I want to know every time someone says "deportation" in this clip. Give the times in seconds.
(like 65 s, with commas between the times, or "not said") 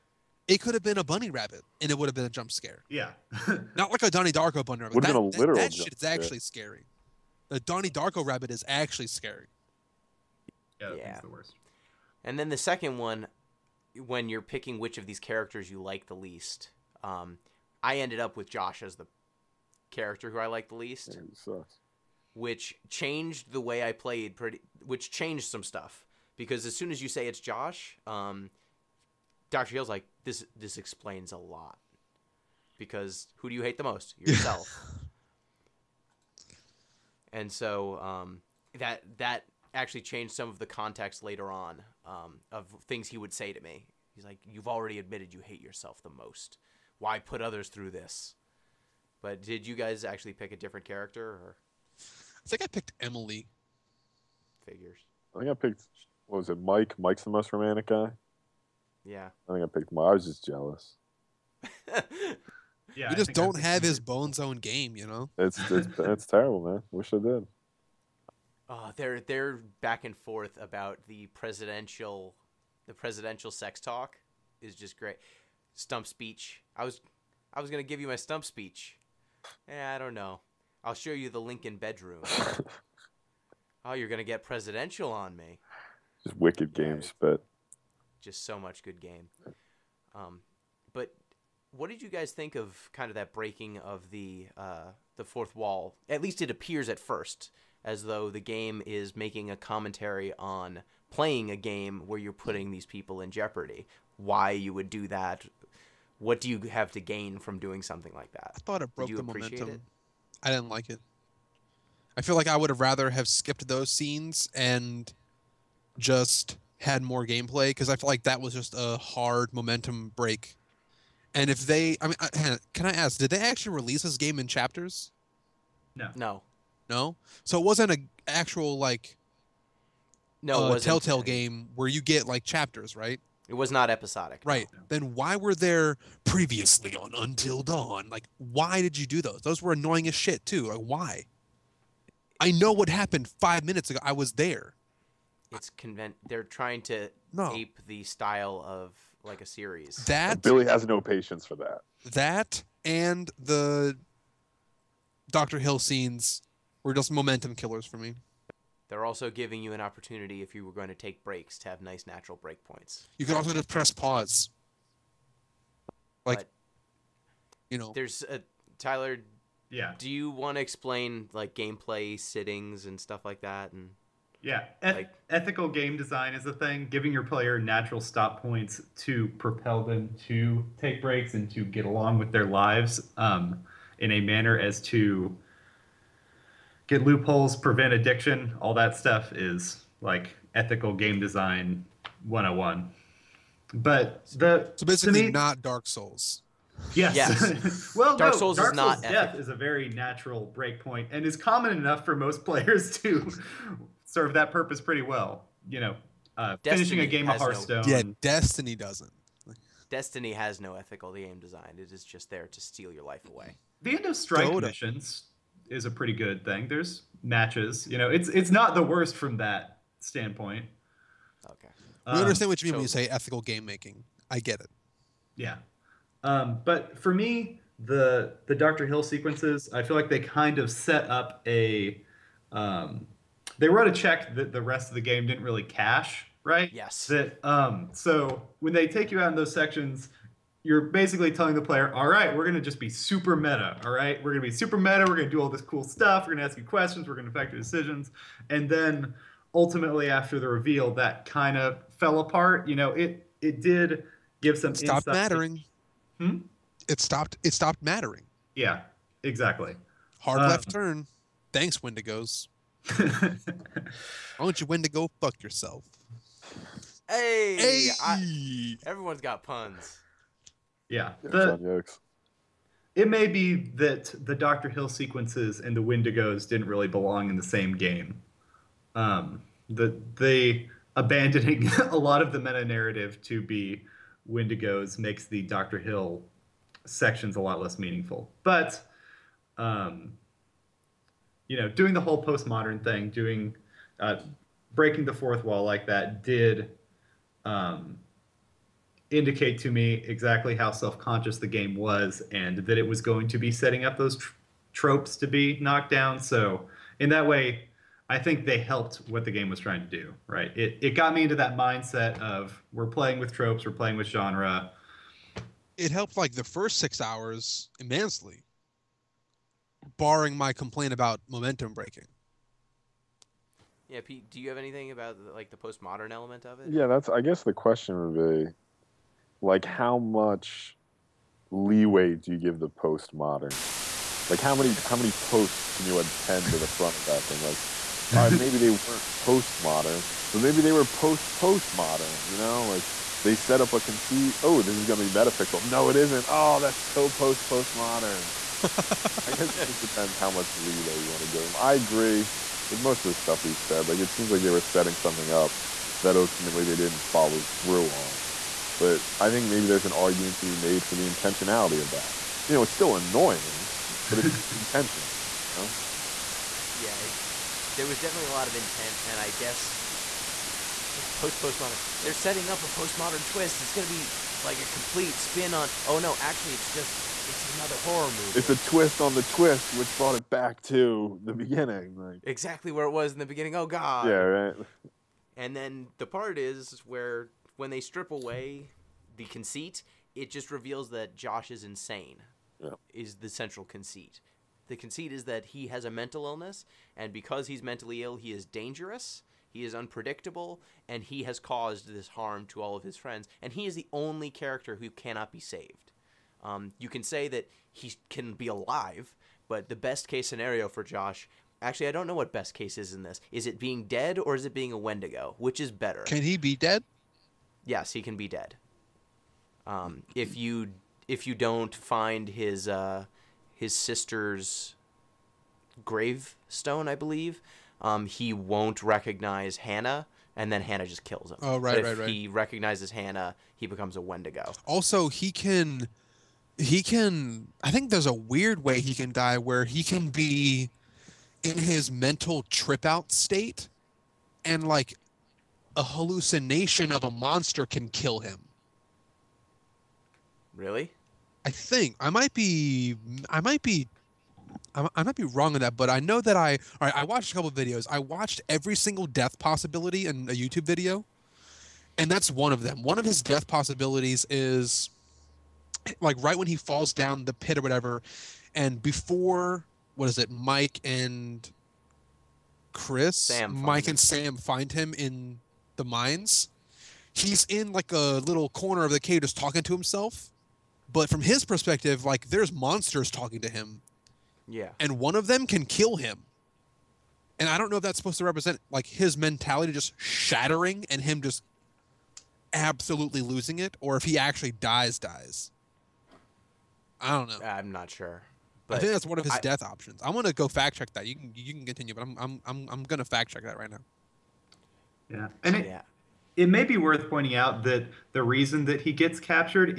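not said.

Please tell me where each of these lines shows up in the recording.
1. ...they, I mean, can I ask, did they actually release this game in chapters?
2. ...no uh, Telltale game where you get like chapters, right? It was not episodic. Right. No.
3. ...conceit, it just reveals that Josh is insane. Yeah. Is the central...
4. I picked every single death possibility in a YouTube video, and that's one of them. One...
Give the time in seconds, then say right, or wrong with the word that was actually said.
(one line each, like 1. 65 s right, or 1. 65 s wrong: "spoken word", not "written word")
1. 121 s right
2. 130 s right
3. 389 s right
4. 457 s wrong: "watched", not "picked".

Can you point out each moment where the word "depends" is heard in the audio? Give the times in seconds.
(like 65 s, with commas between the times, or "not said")
349 s.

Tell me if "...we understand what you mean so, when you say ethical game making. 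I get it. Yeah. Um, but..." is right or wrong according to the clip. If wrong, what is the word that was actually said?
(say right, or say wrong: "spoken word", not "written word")
right.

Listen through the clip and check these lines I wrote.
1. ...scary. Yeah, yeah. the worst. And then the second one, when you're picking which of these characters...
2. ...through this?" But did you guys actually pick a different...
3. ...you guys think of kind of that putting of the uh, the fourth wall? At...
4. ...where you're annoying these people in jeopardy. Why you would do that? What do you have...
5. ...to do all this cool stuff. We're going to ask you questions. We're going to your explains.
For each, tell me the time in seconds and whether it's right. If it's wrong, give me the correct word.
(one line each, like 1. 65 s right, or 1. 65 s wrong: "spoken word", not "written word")
1. 9 s right
2. 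47 s right
3. 92 s wrong: "breaking", not "putting"
4. 102 s wrong: "putting", not "annoying"
5. 245 s wrong: "decisions", not "explains".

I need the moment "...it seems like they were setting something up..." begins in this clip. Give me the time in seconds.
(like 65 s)
353 s.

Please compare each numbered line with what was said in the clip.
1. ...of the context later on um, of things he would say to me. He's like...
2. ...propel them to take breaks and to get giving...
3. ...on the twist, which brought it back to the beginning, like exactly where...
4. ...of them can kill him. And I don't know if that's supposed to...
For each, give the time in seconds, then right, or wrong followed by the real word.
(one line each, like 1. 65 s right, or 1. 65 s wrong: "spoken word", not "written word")
1. 40 s right
2. 179 s wrong: "along", not "giving"
3. 379 s right
4. 485 s right.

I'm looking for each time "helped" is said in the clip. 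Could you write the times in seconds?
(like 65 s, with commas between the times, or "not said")
308 s, 315 s.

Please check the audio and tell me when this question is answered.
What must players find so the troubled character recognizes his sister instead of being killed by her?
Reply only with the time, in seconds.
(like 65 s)
423 s.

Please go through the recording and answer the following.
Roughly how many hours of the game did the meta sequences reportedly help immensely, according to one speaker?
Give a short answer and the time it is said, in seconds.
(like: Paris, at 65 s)
6, at 316 s.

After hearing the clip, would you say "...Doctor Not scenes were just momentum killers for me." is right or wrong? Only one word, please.
wrong.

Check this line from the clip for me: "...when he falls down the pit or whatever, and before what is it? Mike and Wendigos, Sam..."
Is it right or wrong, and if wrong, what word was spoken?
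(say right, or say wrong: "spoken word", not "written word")
wrong: "Chris", not "Wendigos".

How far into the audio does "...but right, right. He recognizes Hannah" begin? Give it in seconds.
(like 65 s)
431 s.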